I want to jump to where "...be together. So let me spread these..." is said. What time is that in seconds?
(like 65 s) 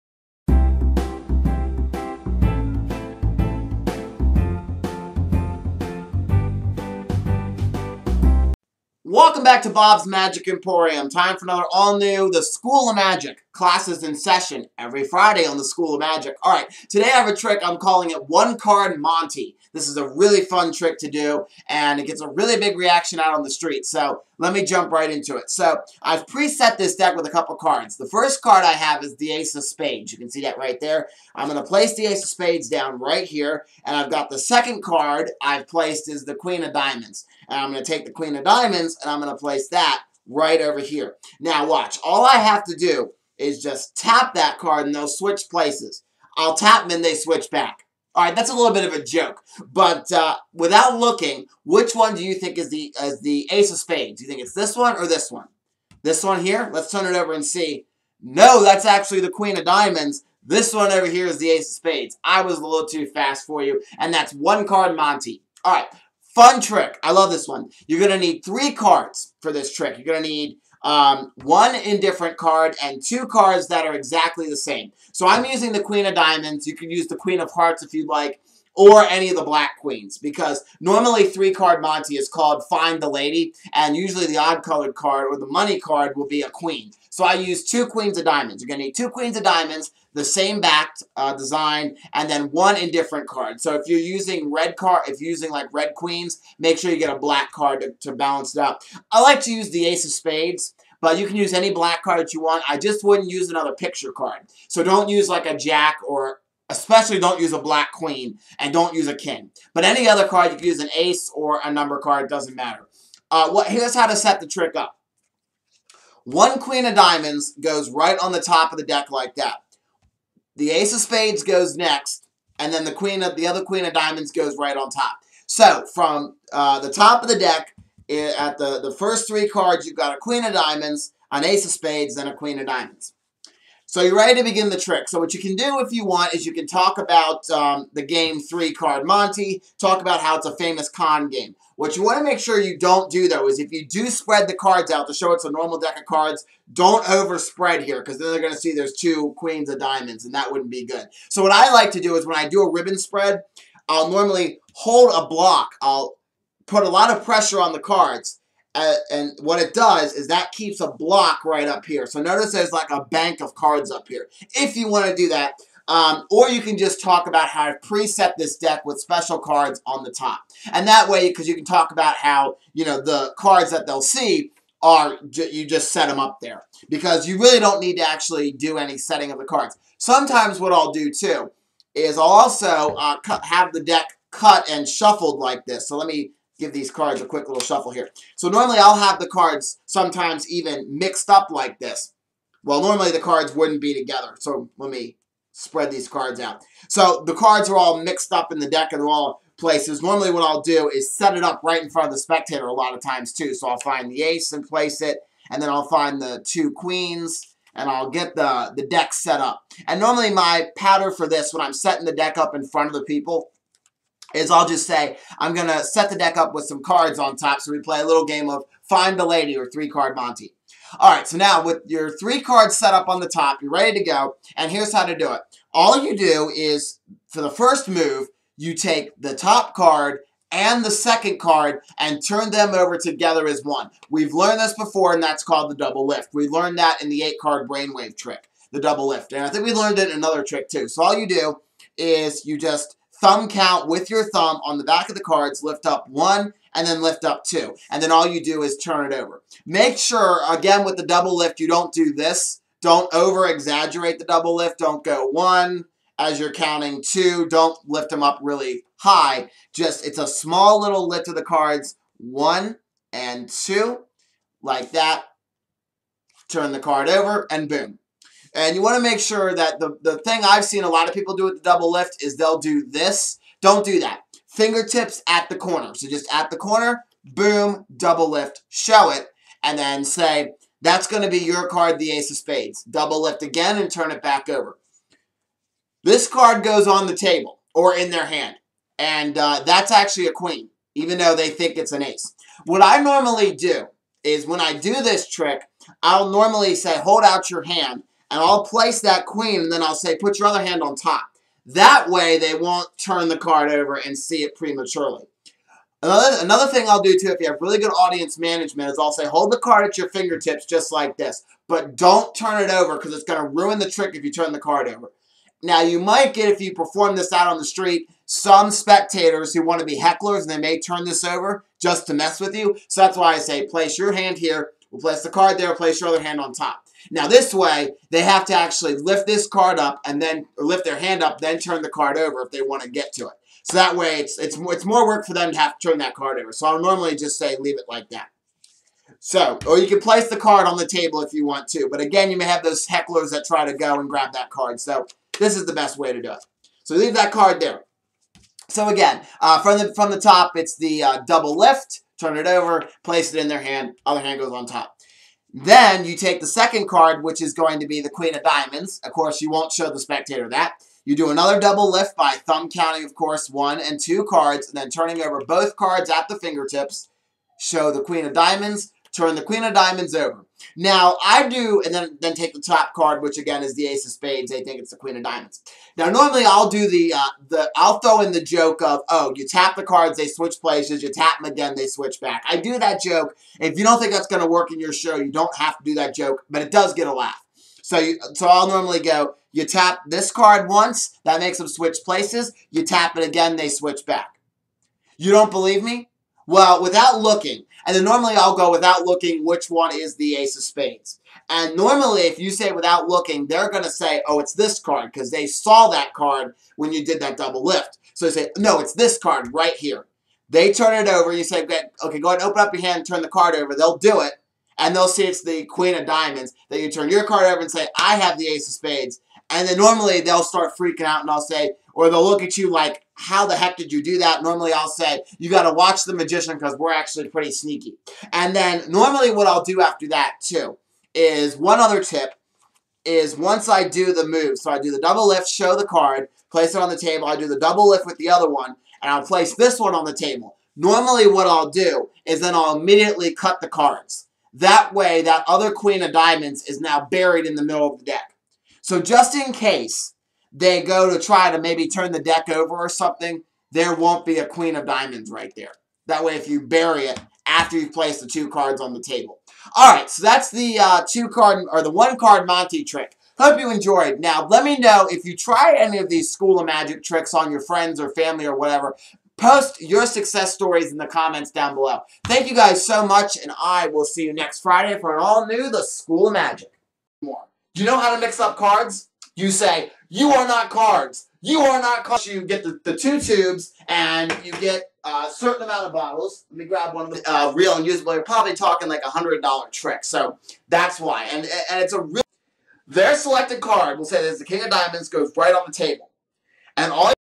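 193 s.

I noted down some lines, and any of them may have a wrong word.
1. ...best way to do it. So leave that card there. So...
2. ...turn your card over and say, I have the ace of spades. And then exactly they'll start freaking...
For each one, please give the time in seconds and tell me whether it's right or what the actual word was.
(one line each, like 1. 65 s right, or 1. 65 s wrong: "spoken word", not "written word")
1. 345 s right
2. 416 s wrong: "normally", not "exactly".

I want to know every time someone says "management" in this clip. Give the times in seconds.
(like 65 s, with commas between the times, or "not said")
308 s.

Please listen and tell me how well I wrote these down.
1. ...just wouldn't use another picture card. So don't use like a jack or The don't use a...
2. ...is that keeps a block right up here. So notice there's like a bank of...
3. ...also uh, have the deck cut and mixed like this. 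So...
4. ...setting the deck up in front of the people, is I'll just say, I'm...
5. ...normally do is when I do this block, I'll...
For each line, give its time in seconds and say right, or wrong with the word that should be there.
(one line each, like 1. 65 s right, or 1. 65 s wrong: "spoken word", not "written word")
1. 102 s wrong: "Especially", not "The"
2. 160 s right
3. 182 s wrong: "shuffled", not "mixed"
4. 211 s right
5. 292 s wrong: "trick", not "block".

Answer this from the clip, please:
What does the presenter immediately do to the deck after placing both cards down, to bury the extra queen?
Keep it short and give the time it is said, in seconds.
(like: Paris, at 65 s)
cut the cards, at 443 s.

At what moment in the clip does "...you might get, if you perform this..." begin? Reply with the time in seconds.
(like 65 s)
315 s.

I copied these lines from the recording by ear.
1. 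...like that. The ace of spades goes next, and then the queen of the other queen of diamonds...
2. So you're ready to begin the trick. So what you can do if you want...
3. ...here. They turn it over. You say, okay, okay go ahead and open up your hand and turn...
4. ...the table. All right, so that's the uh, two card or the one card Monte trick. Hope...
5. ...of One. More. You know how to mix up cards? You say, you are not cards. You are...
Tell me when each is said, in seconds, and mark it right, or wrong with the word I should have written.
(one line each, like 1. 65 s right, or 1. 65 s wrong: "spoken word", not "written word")
1. 119 s right
2. 133 s right
3. 409 s right
4. 458 s right
5. 476 s wrong: "Magic", not "One".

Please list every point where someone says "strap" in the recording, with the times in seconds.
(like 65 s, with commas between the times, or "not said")
not said.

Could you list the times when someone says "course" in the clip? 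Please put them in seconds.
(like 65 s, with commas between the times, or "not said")
359 s, 363 s.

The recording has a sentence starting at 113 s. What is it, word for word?
Uh, what, here's how to set the trick up.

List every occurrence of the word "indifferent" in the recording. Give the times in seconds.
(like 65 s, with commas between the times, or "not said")
71 s, 92 s.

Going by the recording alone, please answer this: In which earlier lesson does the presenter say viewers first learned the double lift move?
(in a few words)
eight-card brainwave trick.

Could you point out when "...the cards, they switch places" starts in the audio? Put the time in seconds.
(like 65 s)
379 s.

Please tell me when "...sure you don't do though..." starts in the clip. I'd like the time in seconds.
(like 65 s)
142 s.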